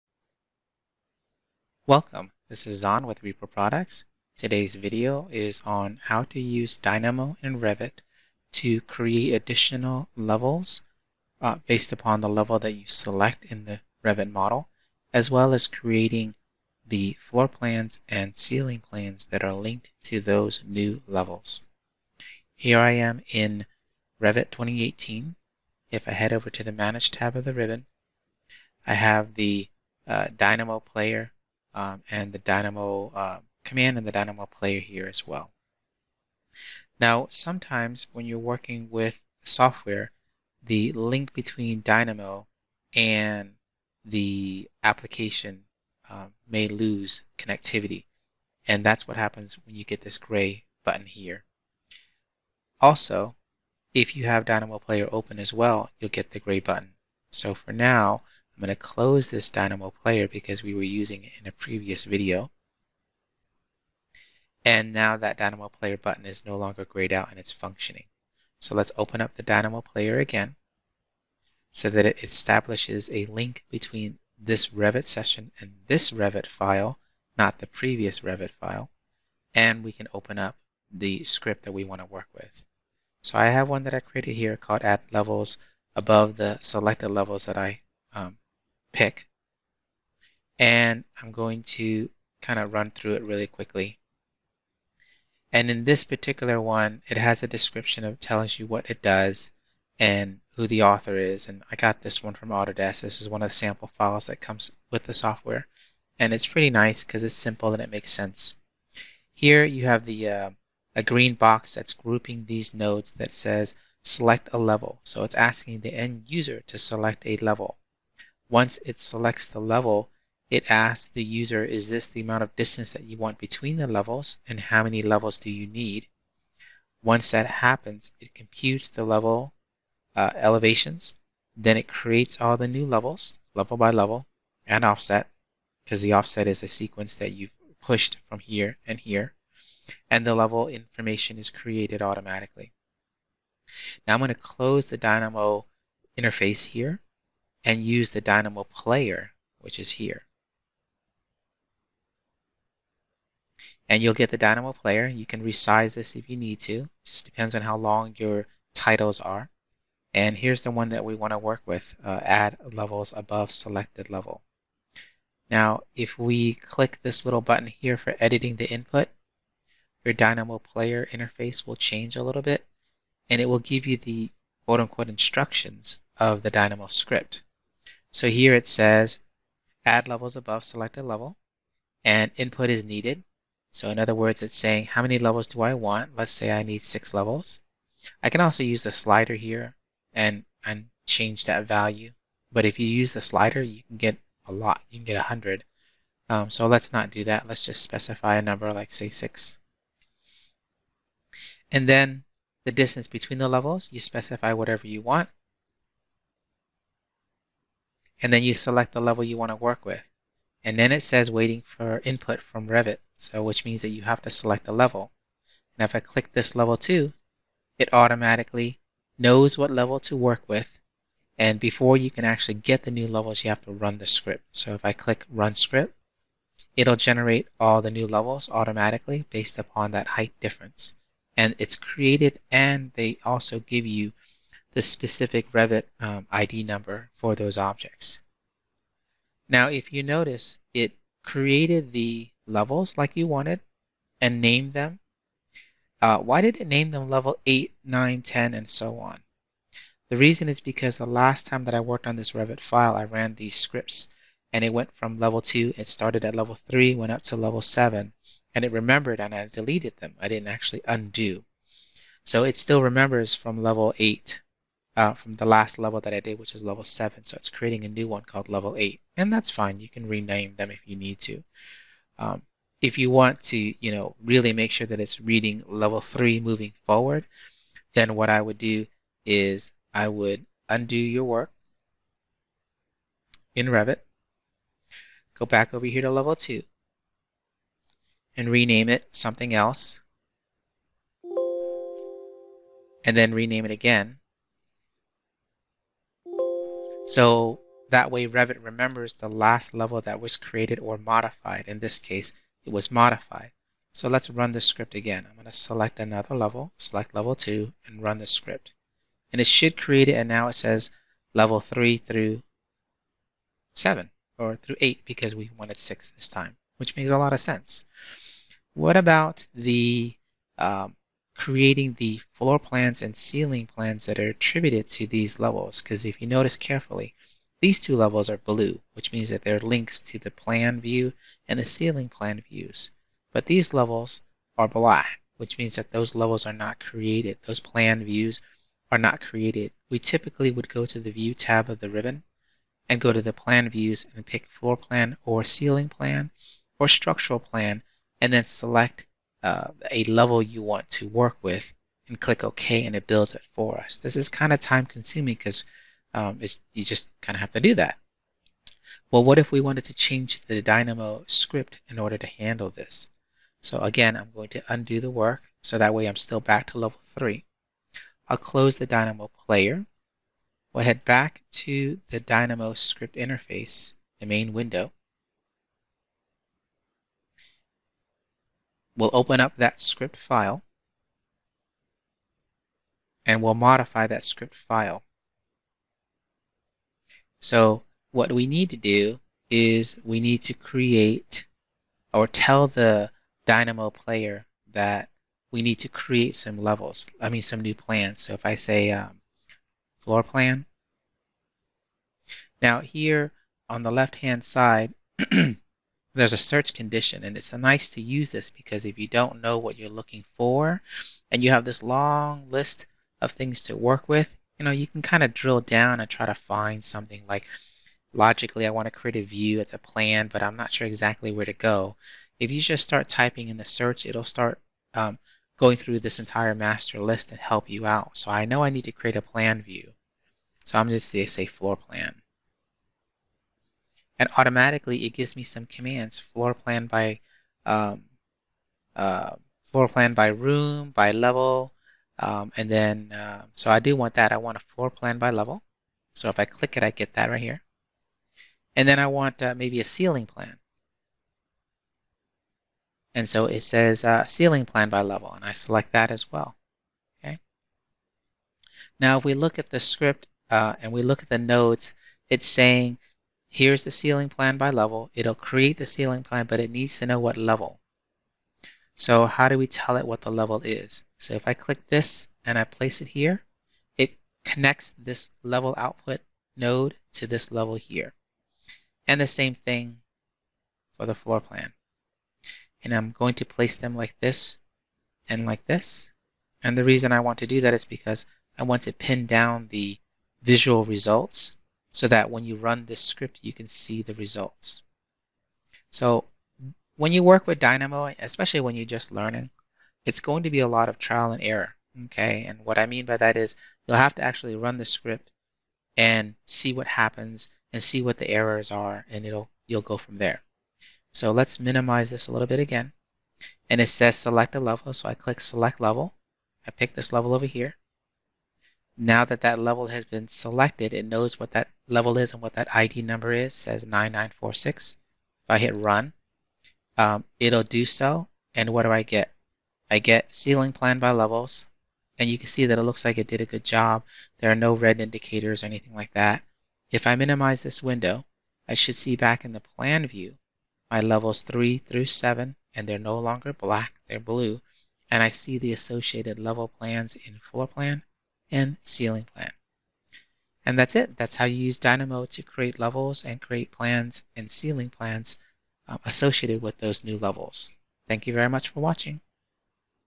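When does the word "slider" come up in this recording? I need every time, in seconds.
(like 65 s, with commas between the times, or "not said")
188 s, 193 s.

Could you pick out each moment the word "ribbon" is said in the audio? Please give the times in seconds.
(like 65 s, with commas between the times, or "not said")
27 s, 341 s.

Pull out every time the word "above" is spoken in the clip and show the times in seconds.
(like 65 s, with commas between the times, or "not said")
85 s, 163 s, 180 s.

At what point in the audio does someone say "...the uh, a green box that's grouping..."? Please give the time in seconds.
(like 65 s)
110 s.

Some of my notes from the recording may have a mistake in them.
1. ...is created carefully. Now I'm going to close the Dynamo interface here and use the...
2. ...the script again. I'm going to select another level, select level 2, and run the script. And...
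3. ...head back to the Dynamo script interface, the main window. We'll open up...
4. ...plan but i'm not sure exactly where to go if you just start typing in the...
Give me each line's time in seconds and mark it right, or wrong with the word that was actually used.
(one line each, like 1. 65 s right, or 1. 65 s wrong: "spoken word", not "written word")
1. 141 s wrong: "automatically", not "carefully"
2. 304 s right
3. 370 s right
4. 419 s right.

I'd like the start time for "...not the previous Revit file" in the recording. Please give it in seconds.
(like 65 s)
77 s.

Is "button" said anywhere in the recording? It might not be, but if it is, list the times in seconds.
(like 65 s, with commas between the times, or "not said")
50 s, 56 s, 65 s, 167 s.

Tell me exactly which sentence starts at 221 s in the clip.
And before you can actually get the new levels, you have to run the script.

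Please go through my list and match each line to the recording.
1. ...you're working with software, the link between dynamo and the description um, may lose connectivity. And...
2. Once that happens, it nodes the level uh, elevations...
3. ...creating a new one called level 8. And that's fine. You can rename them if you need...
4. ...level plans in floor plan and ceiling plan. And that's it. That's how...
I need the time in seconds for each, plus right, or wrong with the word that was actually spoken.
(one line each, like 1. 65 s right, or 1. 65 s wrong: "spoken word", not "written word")
1. 38 s wrong: "application", not "description"
2. 127 s wrong: "computes", not "nodes"
3. 267 s right
4. 546 s right.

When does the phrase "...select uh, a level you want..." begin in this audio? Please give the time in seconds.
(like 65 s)
348 s.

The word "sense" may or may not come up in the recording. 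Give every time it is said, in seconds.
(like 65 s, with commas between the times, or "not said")
108 s, 317 s.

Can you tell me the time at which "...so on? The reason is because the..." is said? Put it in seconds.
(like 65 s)
248 s.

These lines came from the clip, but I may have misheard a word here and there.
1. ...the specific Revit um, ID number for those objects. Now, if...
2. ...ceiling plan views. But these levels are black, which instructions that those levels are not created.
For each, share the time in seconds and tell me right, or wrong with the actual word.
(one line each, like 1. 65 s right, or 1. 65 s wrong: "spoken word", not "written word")
1. 234 s right
2. 331 s wrong: "means", not "instructions".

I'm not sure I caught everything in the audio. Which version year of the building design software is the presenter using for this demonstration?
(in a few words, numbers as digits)
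Revit 2018.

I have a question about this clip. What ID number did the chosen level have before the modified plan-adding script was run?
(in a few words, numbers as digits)
9946.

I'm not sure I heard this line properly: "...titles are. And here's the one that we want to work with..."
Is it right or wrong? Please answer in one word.
right.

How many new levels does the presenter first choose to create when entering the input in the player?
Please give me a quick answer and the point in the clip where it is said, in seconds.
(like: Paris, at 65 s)
6, at 186 s.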